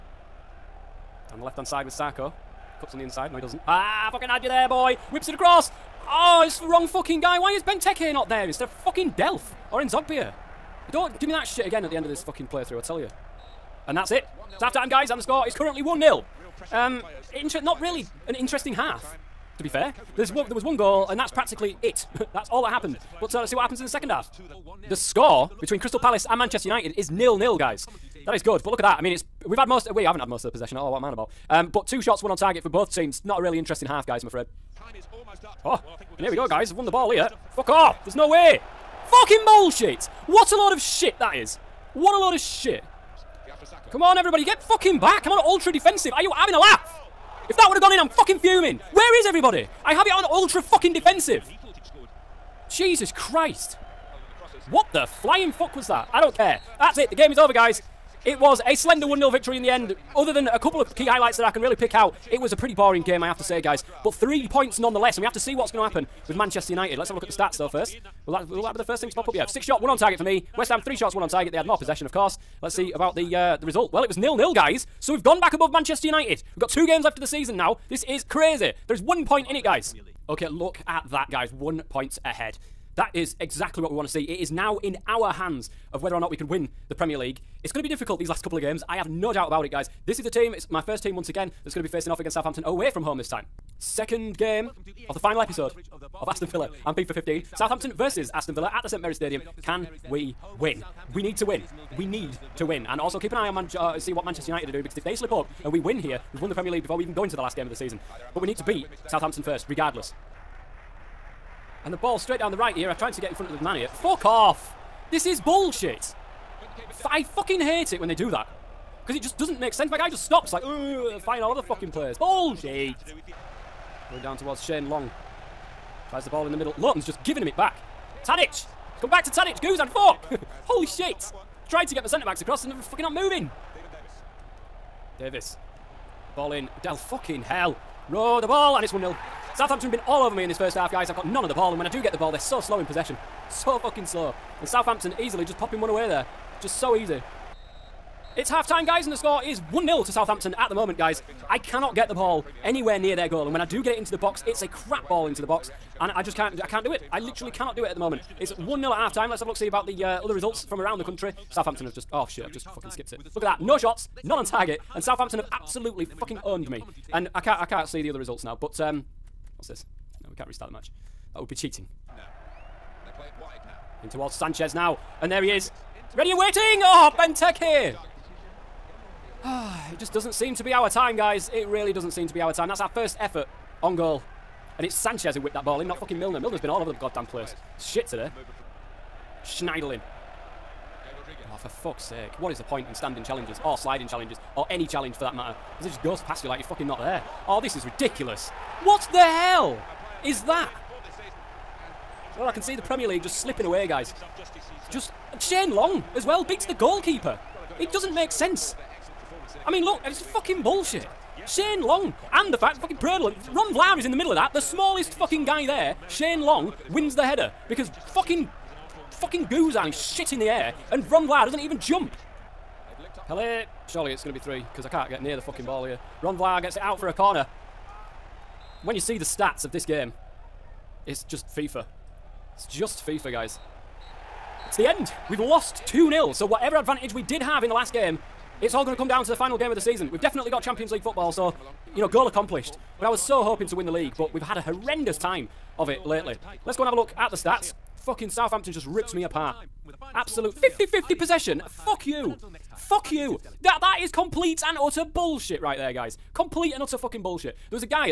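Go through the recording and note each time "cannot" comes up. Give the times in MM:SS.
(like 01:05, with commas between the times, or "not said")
02:31, 02:37.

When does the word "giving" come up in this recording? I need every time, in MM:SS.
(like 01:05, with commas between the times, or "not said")
02:07.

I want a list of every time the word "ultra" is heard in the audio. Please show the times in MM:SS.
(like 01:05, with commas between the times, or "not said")
00:45, 00:50.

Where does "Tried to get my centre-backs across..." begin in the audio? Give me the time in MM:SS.
02:11.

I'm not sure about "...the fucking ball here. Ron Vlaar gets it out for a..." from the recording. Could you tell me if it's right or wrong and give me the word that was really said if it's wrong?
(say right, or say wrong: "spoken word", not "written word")
right.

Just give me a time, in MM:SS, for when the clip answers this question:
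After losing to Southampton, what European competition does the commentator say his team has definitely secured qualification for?
04:00.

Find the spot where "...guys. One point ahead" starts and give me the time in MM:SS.
01:21.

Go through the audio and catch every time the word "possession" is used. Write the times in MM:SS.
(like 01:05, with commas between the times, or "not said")
00:30, 01:11, 02:22, 04:11.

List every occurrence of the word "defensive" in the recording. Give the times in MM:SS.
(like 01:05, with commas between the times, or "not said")
00:45, 00:50.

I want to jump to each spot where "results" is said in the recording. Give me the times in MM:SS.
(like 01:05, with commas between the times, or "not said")
01:13, 02:40, 02:48.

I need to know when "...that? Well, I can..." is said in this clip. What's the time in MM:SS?
03:20.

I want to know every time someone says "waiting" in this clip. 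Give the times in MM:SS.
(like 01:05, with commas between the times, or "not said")
02:56.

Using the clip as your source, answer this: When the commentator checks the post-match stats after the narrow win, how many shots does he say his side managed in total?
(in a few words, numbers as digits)
6.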